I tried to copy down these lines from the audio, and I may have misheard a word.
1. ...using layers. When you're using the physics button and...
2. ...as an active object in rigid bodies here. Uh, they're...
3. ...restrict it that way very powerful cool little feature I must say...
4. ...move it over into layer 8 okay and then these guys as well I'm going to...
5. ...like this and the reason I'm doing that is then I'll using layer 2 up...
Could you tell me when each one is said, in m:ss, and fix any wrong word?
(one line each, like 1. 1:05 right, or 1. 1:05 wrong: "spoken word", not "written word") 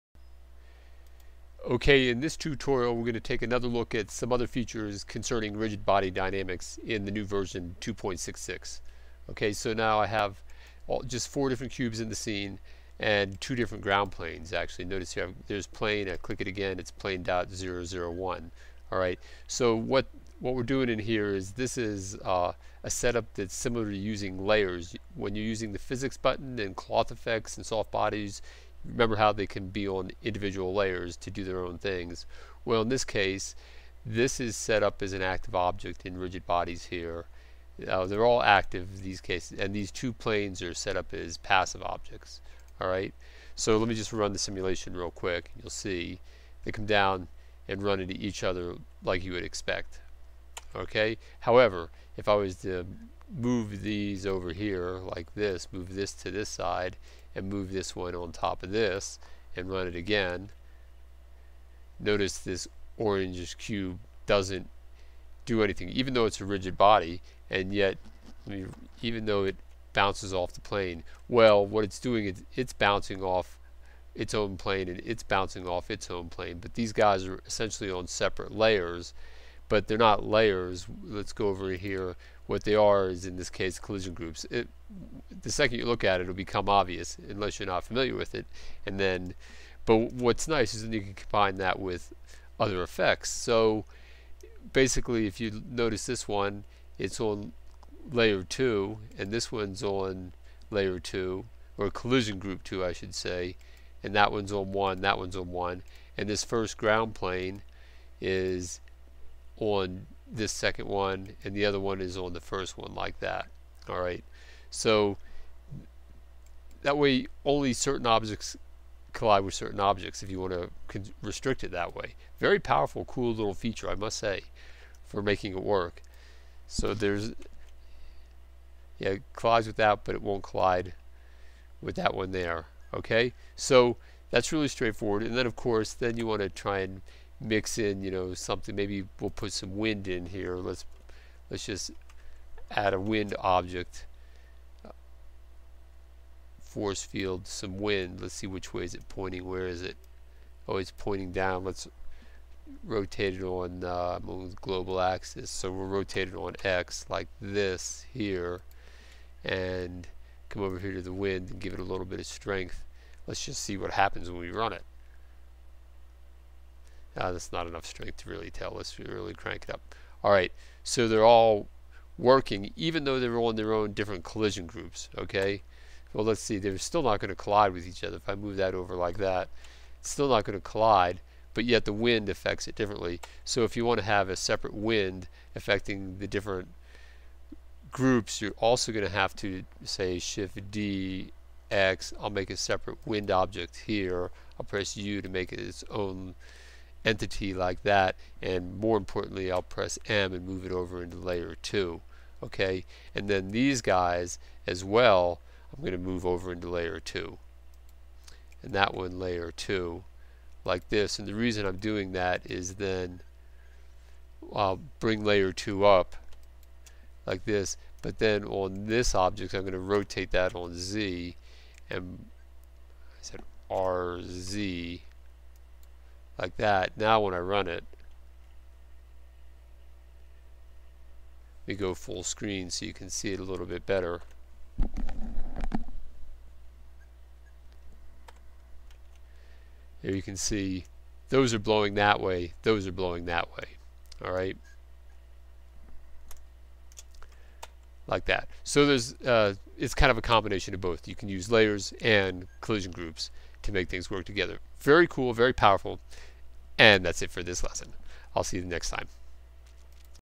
1. 0:23 right
2. 0:35 right
3. 2:01 right
4. 3:20 wrong: "2", not "8"
5. 3:30 wrong: "bring", not "using".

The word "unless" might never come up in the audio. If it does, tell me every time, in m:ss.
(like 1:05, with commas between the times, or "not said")
1:27.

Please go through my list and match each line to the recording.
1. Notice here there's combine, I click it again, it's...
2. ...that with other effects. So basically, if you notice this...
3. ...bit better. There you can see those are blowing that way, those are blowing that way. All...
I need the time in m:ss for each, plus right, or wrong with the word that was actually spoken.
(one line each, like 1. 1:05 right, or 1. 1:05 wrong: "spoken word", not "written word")
1. 0:14 wrong: "plane", not "combine"
2. 1:31 right
3. 3:53 right.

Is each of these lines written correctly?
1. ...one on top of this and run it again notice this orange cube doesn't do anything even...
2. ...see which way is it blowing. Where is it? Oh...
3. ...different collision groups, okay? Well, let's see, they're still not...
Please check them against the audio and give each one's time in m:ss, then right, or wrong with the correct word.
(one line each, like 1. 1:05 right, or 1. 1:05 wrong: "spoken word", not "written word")
1. 0:57 right
2. 2:28 wrong: "pointing", not "blowing"
3. 2:53 right.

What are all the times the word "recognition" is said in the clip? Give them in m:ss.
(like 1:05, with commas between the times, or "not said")
not said.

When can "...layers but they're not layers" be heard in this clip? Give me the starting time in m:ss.
1:18.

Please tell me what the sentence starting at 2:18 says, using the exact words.
Maybe we'll put some wind in here.